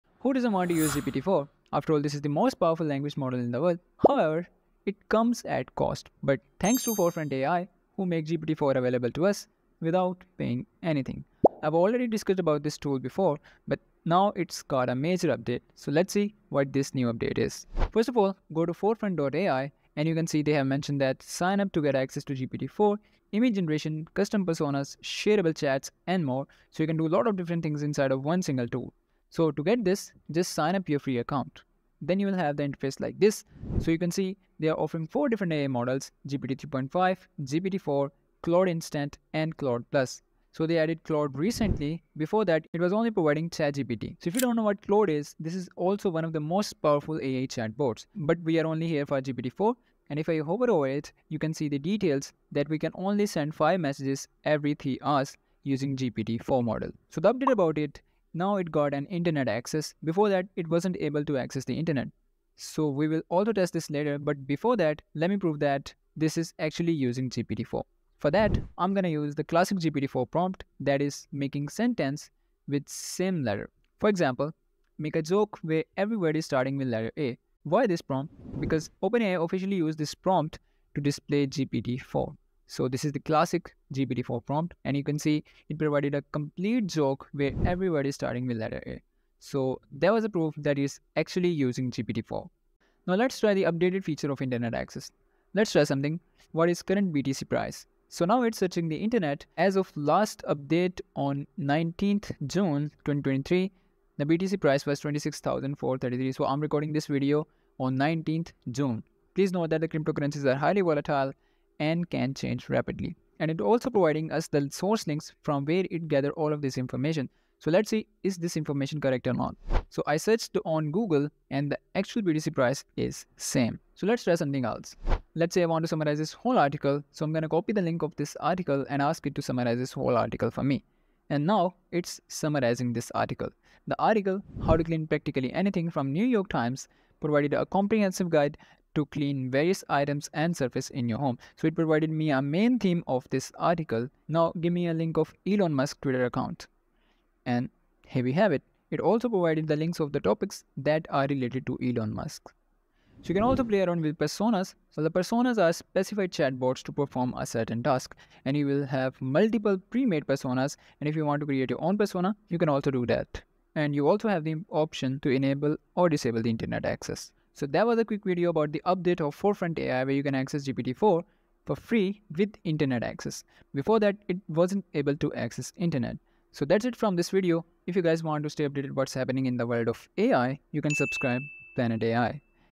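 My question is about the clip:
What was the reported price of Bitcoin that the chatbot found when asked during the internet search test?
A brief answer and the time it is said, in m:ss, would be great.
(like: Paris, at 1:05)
26,433, at 1:45.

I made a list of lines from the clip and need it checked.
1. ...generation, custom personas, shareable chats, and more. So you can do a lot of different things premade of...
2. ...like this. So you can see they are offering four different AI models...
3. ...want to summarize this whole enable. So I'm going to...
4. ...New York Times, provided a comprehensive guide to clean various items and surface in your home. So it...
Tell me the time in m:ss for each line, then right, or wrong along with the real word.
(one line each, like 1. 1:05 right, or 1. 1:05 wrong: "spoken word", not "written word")
1. 0:23 wrong: "inside", not "premade"
2. 0:32 right
3. 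2:05 wrong: "article", not "enable"
4. 2:16 right.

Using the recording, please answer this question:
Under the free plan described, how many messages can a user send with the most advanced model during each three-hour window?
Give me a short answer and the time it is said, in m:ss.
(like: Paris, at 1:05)
5, at 0:53.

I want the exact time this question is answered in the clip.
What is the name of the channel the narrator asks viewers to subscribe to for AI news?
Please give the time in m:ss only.
3:01.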